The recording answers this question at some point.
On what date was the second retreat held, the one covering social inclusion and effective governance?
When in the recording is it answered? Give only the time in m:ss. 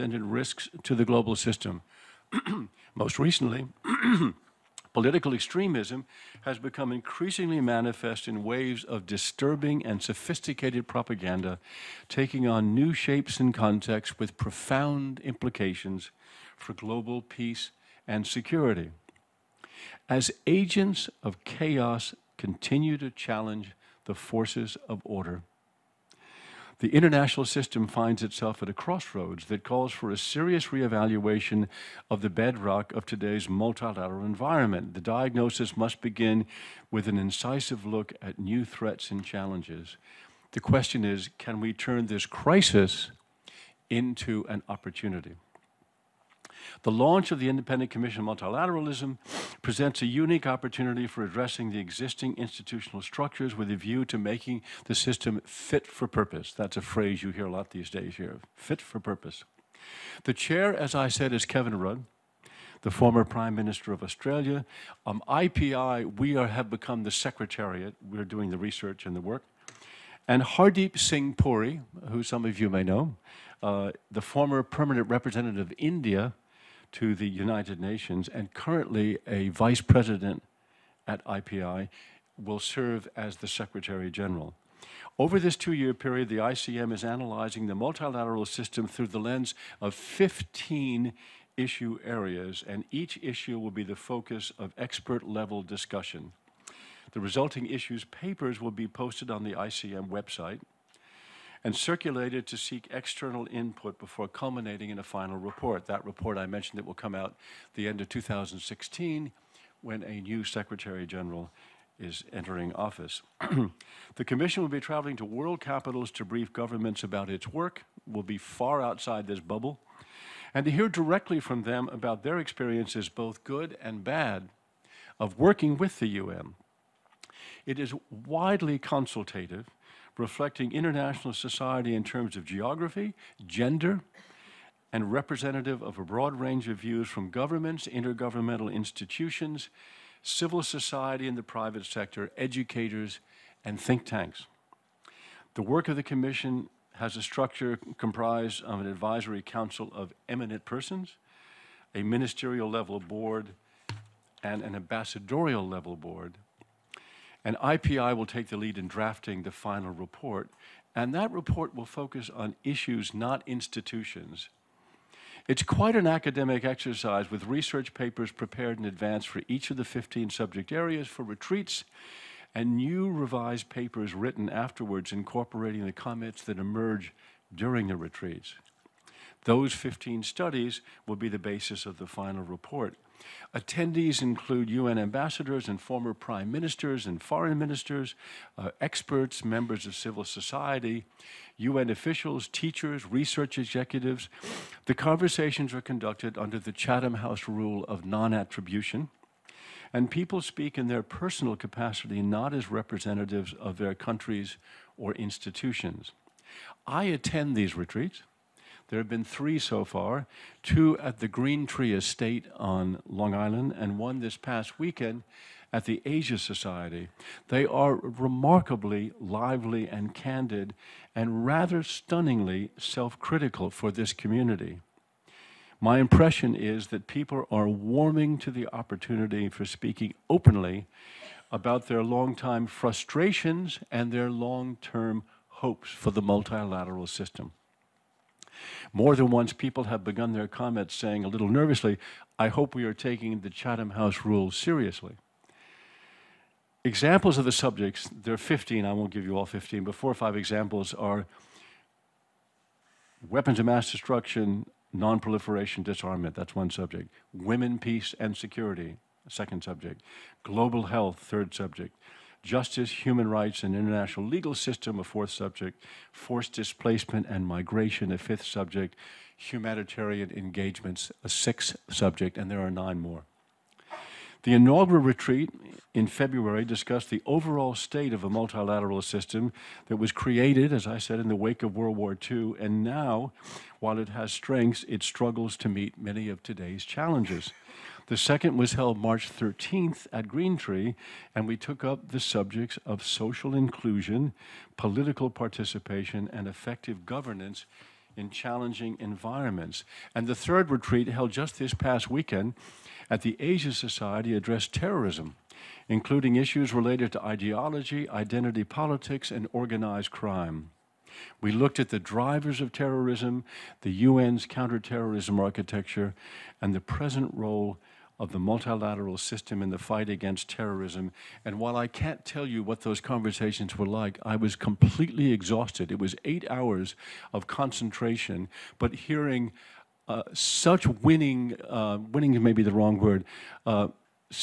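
4:48.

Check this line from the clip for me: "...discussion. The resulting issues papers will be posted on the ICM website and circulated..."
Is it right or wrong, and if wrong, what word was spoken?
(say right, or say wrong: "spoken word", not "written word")
right.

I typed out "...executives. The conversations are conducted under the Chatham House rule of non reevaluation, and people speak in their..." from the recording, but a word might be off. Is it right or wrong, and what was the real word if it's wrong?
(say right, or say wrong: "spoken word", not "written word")
wrong: "attribution", not "reevaluation".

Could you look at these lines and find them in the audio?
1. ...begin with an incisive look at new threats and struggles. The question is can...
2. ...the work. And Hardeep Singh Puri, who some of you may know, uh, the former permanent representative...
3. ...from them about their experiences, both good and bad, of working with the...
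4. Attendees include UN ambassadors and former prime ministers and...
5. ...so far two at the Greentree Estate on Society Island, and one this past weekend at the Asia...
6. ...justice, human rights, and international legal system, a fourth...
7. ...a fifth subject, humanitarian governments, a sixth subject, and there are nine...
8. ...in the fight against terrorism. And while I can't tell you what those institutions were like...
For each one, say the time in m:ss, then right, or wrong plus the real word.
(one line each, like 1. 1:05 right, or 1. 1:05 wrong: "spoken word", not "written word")
1. 0:36 wrong: "challenges", not "struggles"
2. 1:09 right
3. 2:01 right
4. 3:03 right
5. 3:29 wrong: "Long", not "Society"
6. 4:22 right
7. 4:28 wrong: "engagements", not "governments"
8. 5:19 wrong: "conversations", not "institutions".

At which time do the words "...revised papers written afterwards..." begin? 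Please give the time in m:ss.
2:53.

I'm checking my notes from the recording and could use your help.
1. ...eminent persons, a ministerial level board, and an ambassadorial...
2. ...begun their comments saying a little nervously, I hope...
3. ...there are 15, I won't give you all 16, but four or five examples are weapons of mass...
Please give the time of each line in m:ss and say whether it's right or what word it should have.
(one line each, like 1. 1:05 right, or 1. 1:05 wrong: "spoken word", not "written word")
1. 2:30 right
2. 4:00 right
3. 4:08 wrong: "15", not "16".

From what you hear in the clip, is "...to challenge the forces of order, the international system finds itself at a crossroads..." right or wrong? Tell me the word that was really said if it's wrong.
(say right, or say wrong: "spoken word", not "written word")
right.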